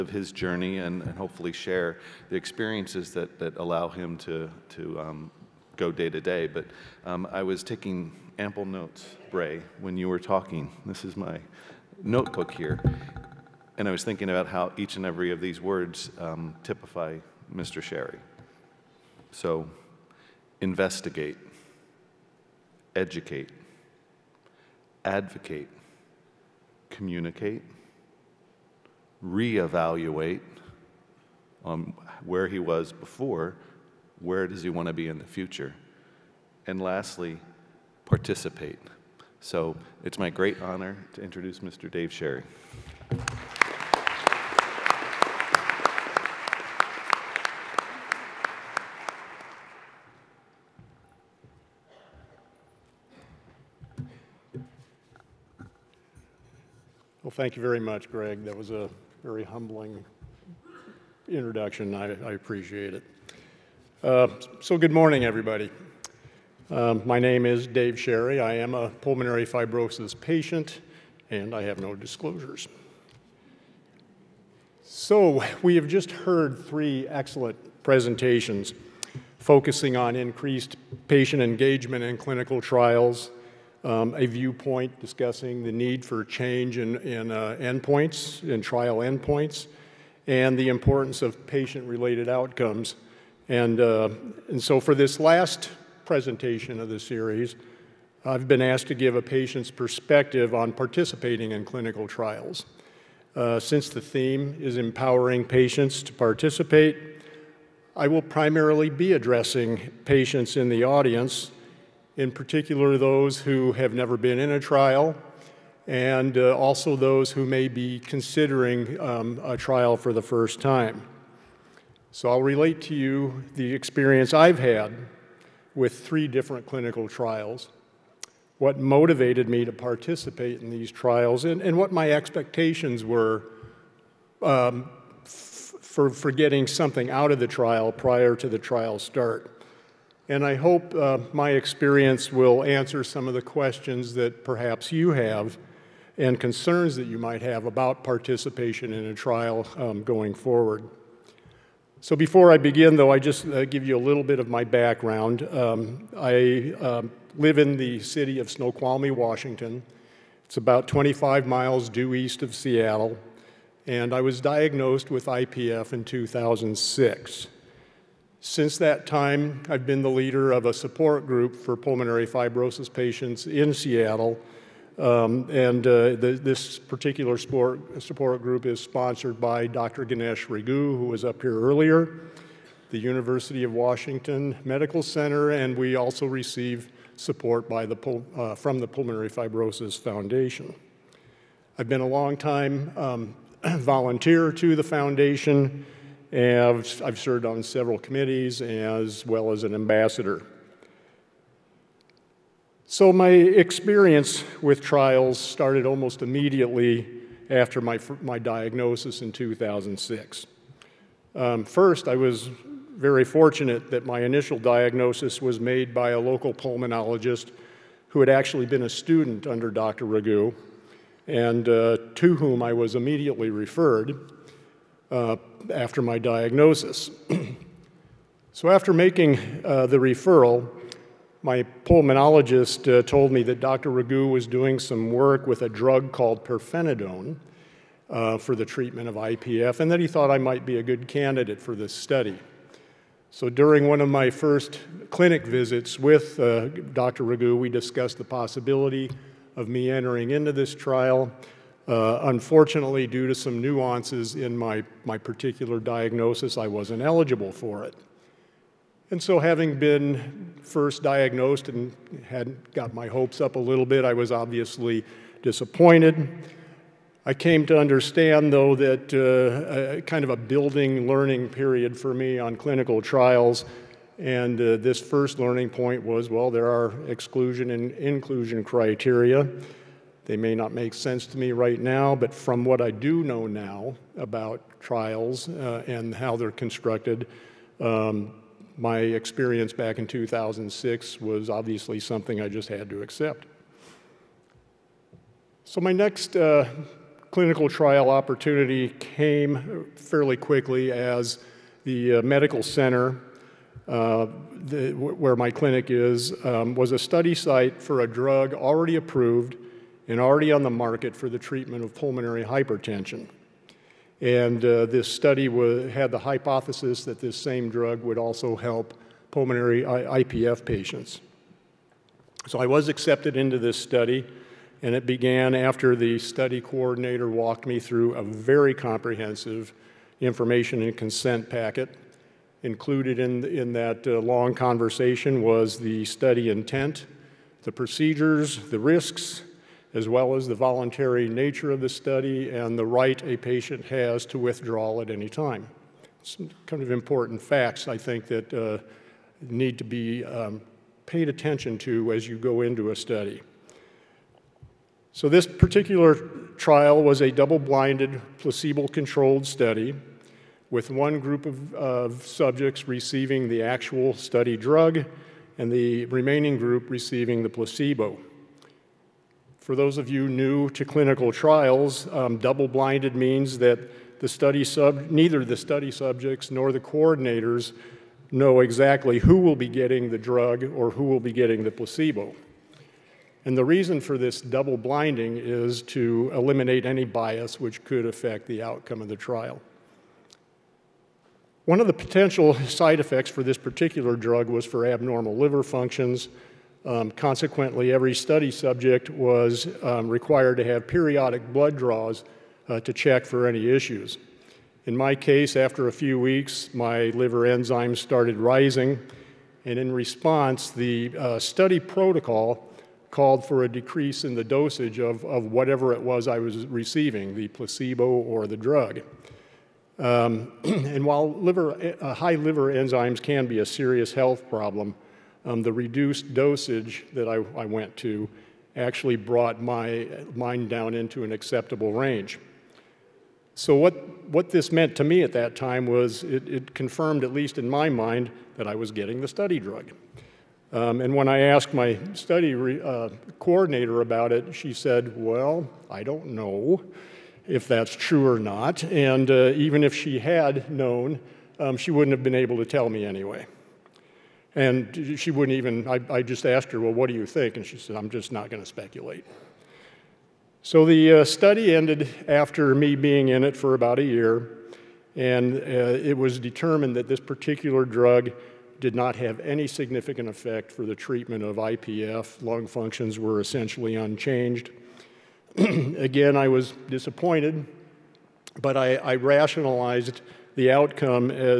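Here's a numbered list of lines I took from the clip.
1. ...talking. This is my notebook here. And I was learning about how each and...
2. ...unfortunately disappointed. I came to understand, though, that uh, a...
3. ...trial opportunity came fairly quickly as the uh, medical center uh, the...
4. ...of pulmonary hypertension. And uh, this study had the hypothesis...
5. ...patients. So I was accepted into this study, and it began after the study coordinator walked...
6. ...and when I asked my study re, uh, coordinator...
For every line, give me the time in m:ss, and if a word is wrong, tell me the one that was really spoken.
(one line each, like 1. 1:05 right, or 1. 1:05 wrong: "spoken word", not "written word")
1. 0:10 wrong: "thinking", not "learning"
2. 4:24 wrong: "obviously", not "unfortunately"
3. 4:57 right
4. 5:11 right
5. 5:20 right
6. 7:21 right.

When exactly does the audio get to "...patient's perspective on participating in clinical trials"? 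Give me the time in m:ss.
1:39.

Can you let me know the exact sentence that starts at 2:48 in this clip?
Since that time, I've been the leader of a support group for pulmonary fibrosis patients in Seattle.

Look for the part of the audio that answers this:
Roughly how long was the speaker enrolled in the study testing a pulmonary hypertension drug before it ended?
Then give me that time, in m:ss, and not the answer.
7:43.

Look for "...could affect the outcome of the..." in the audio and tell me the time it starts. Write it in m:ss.
6:27.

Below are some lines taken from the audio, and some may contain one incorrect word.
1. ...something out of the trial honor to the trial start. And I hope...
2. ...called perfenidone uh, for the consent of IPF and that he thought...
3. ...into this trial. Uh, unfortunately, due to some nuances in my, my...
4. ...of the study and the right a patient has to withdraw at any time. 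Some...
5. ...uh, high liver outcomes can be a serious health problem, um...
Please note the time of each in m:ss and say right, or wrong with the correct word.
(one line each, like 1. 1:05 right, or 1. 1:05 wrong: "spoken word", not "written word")
1. 2:16 wrong: "prior", not "honor"
2. 3:56 wrong: "treatment", not "consent"
3. 4:10 right
4. 5:41 right
5. 7:02 wrong: "enzymes", not "outcomes".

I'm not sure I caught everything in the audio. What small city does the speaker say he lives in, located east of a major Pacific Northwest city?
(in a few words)
Snoqualmie.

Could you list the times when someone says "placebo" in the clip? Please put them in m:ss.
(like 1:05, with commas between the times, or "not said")
5:58, 6:07, 6:21, 6:57.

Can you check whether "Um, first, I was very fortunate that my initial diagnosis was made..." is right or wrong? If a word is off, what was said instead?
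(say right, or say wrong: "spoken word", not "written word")
right.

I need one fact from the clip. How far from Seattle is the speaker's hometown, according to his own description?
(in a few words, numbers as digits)
25 miles.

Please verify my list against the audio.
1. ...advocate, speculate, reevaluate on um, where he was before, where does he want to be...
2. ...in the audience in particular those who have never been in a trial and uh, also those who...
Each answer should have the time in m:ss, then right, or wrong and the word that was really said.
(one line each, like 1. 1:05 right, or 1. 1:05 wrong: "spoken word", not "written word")
1. 0:25 wrong: "communicate", not "speculate"
2. 1:50 right.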